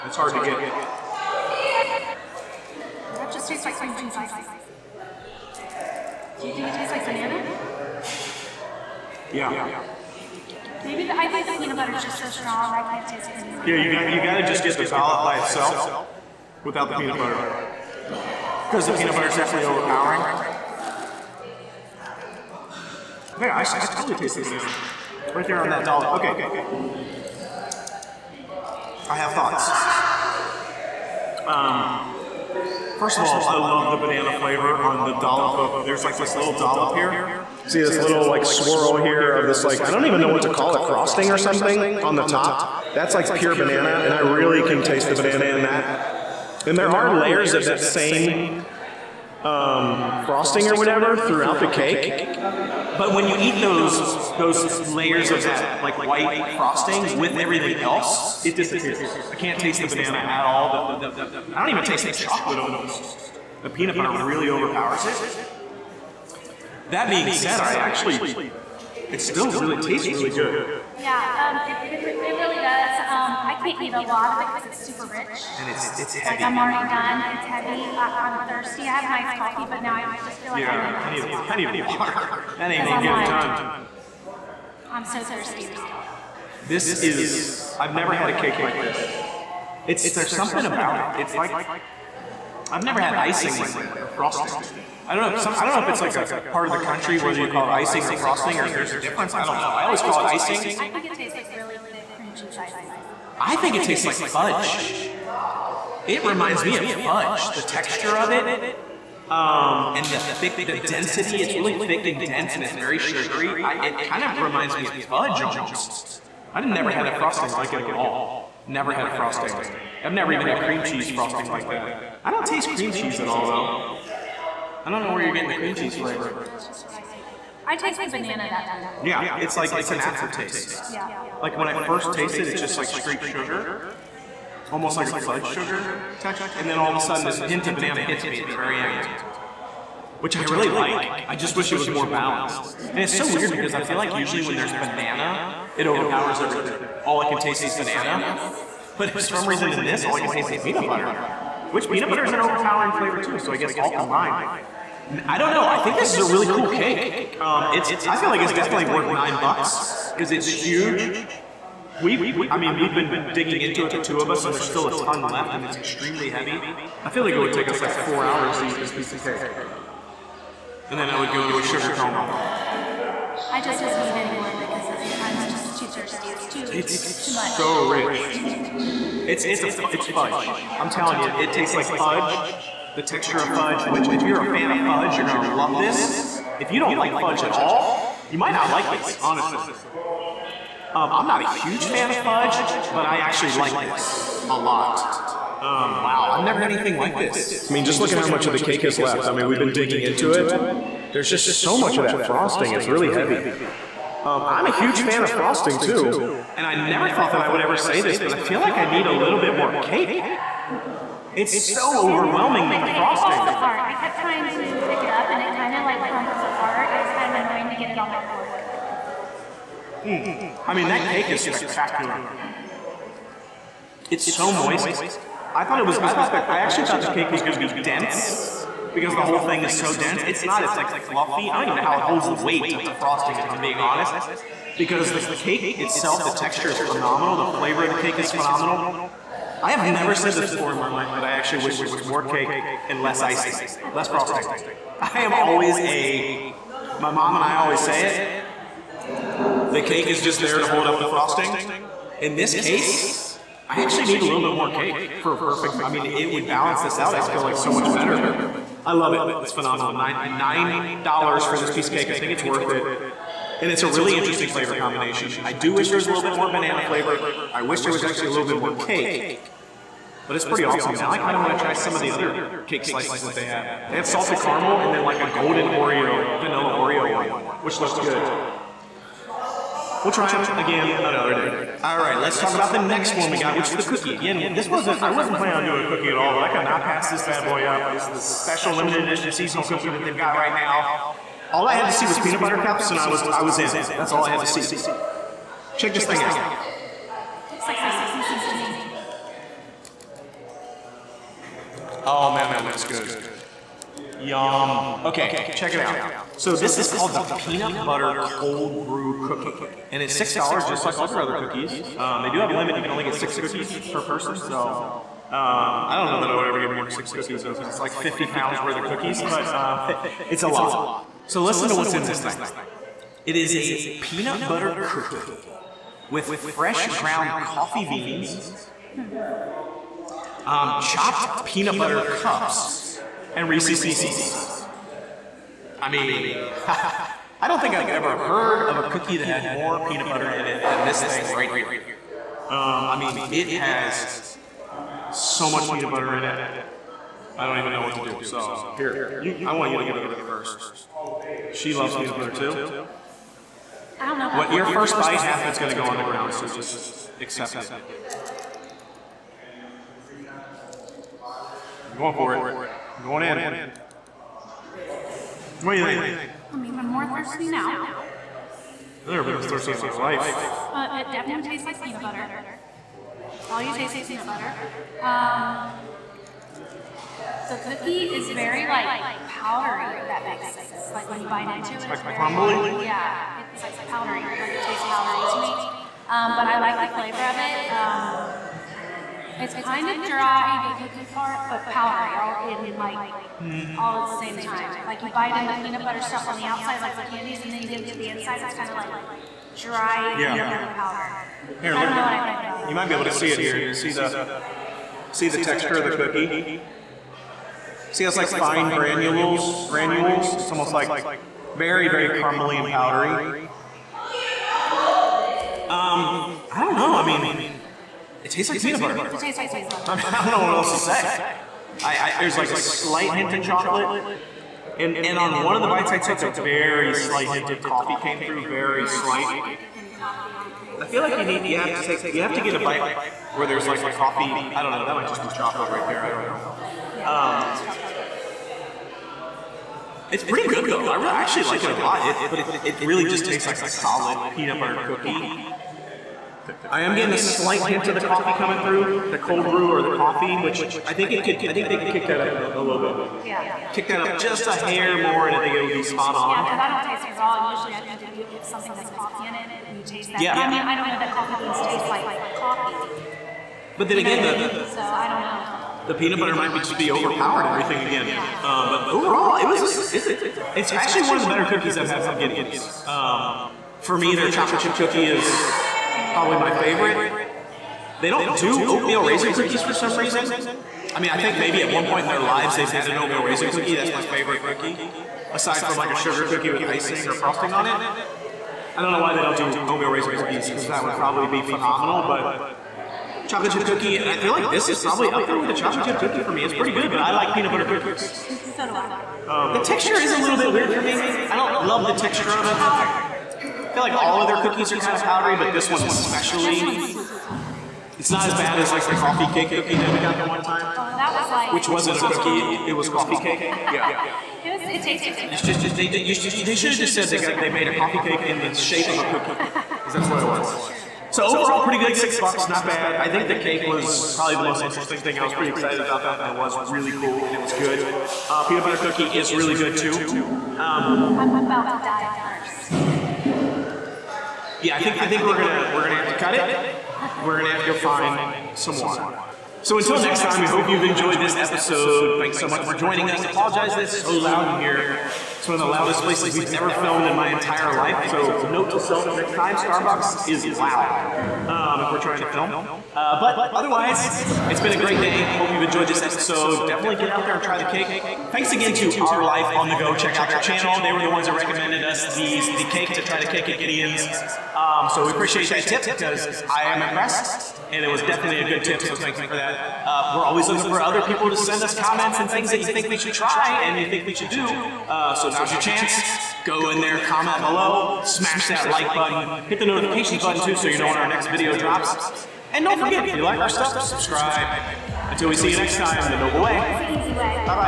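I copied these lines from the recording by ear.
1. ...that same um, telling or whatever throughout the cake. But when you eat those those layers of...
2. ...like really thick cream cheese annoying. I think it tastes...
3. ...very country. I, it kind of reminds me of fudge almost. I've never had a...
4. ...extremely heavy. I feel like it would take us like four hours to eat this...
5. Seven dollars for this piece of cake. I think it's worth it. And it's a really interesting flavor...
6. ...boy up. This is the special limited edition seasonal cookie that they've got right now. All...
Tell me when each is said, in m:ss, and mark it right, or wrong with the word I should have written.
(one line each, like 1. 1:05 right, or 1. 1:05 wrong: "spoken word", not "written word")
1. 0:47 wrong: "frosting", not "telling"
2. 1:41 wrong: "icing", not "annoying"
3. 1:52 wrong: "sugary", not "country"
4. 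2:45 right
5. 4:19 wrong: "Nine", not "Seven"
6. 4:47 right.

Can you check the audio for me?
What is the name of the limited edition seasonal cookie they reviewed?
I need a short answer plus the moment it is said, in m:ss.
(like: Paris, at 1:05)
Peanut butter cold brew cookie, at 5:07.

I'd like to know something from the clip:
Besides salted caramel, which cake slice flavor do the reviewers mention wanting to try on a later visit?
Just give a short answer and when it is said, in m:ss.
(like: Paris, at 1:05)
Golden Oreo, at 4:35.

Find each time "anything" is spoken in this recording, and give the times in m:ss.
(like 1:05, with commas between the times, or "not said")
0:13, 3:16.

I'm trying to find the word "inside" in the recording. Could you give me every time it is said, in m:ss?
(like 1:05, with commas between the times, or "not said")
6:38.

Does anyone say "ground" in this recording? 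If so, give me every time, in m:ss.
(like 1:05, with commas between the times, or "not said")
5:26, 5:56.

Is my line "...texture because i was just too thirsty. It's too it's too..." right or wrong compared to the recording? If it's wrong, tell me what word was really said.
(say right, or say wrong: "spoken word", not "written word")
wrong: "anymore", not "texture".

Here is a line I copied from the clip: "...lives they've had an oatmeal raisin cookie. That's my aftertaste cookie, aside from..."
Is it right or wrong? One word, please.
wrong.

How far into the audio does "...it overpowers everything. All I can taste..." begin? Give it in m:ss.
2:25.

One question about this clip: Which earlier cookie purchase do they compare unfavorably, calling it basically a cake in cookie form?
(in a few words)
Coffee cake cookie.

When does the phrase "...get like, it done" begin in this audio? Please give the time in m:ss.
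1:23.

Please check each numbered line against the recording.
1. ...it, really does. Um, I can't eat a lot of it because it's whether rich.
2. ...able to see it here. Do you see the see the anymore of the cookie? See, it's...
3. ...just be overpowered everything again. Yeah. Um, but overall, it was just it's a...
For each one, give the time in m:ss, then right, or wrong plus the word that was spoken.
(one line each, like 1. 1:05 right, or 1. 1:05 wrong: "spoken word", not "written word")
1. 1:12 wrong: "super", not "whether"
2. 6:42 wrong: "texture", not "anymore"
3. 7:46 right.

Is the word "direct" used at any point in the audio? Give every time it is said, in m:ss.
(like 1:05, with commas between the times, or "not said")
not said.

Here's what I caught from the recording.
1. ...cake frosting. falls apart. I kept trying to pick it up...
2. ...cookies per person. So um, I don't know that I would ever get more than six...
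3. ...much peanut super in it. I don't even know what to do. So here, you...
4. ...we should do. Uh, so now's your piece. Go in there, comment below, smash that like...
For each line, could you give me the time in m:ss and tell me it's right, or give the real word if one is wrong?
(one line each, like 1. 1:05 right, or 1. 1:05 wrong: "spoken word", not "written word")
1. 3:32 right
2. 5:13 right
3. 5:45 wrong: "butter", not "super"
4. 9:34 wrong: "chance", not "piece".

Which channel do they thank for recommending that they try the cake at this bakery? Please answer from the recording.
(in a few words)
Our Life on the Go.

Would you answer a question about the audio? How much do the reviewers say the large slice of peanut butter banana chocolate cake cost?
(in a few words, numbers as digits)
$9.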